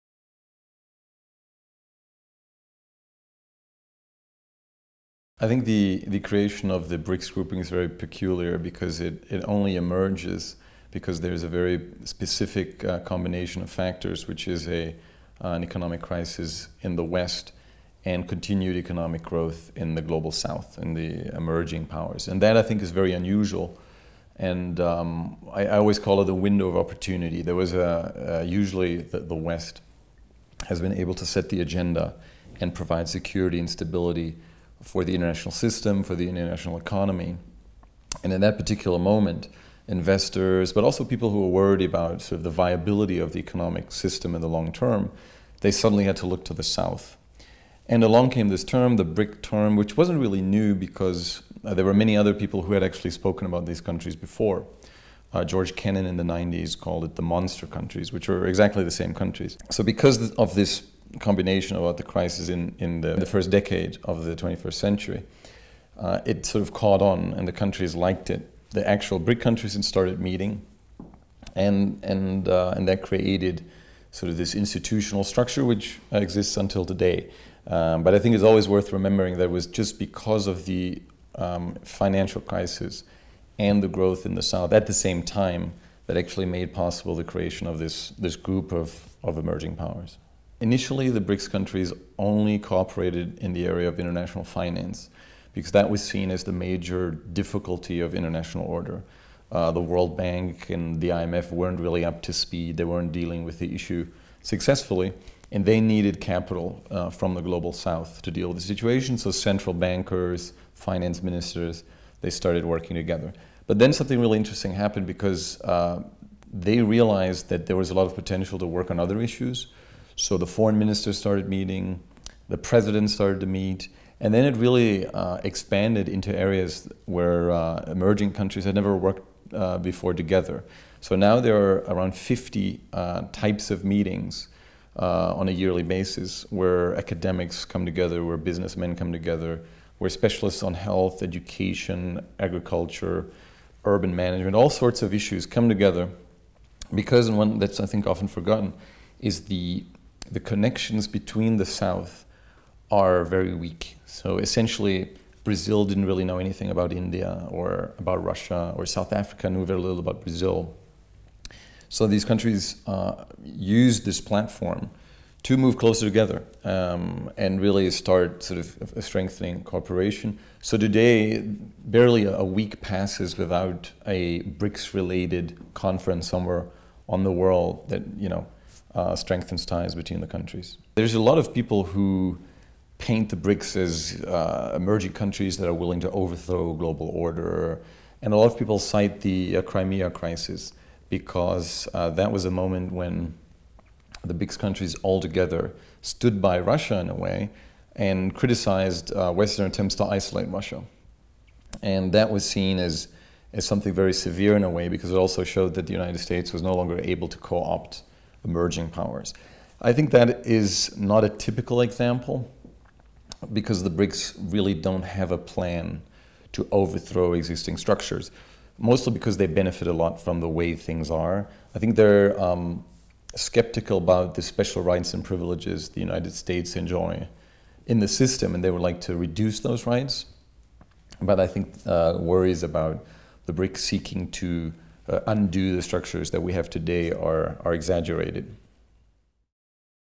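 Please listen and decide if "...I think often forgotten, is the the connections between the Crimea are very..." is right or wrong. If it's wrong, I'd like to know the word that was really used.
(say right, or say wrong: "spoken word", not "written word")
wrong: "South", not "Crimea".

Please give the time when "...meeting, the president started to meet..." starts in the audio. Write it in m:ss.
2:01.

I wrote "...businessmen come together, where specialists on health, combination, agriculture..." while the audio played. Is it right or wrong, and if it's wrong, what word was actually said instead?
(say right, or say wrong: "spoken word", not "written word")
wrong: "education", not "combination".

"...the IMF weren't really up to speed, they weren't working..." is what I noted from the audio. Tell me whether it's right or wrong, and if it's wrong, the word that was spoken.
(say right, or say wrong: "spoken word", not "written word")
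wrong: "dealing", not "working".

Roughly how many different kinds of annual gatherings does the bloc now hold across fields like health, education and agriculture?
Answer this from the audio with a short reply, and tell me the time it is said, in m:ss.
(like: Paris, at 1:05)
50, at 2:12.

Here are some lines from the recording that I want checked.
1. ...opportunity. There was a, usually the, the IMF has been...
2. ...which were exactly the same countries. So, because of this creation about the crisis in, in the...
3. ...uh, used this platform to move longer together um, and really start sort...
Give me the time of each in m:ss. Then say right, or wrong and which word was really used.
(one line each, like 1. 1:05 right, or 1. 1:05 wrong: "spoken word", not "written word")
1. 0:26 wrong: "West", not "IMF"
2. 0:58 wrong: "combination", not "creation"
3. 2:42 wrong: "closer", not "longer".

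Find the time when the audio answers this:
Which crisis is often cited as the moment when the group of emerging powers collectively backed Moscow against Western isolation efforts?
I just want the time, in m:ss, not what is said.
3:09.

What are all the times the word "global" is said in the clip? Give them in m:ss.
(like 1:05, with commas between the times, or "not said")
0:20, 1:47, 3:06.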